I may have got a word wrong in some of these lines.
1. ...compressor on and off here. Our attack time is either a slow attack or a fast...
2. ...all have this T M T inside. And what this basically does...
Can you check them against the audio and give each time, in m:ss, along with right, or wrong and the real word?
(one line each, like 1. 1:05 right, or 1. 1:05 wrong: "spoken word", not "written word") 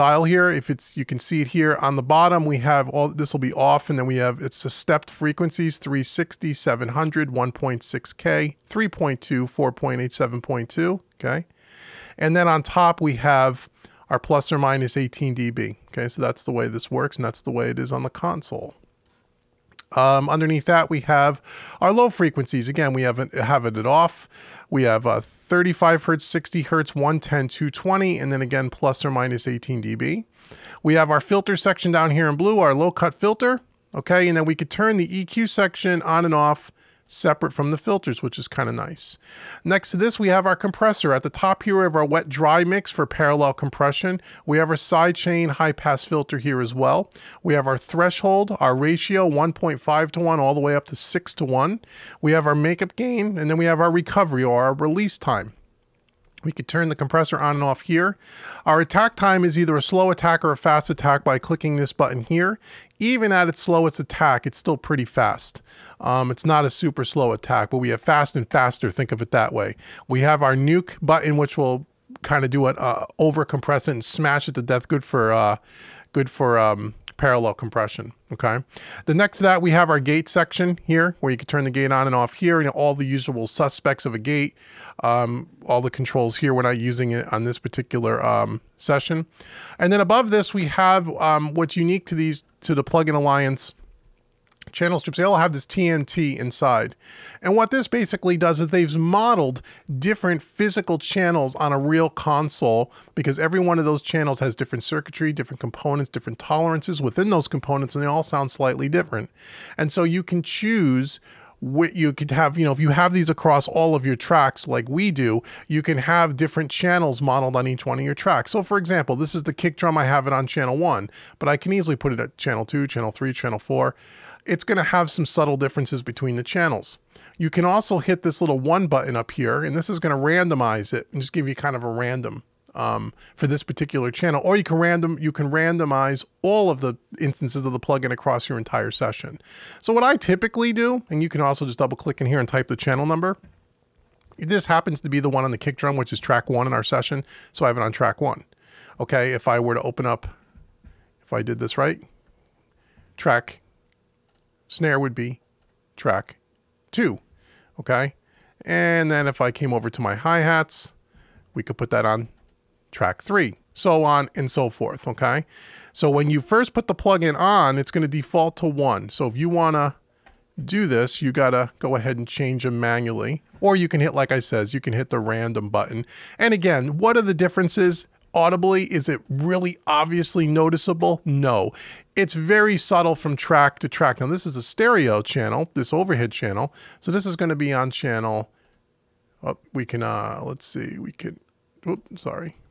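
1. 0:56 right
2. 1:35 right.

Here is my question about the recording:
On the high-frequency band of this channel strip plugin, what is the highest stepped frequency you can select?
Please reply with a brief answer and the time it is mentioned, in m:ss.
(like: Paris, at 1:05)
7.2K, at 0:10.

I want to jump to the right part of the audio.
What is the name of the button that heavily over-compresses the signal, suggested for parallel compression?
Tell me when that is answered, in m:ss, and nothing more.
1:10.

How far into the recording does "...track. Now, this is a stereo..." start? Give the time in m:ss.
3:03.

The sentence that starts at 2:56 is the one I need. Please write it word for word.
And again, what are the differences?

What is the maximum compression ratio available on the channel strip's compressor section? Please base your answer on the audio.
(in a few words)
6 to 1.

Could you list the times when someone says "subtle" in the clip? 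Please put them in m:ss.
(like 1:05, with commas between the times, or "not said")
2:05, 3:02.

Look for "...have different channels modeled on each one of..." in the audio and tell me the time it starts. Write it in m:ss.
1:55.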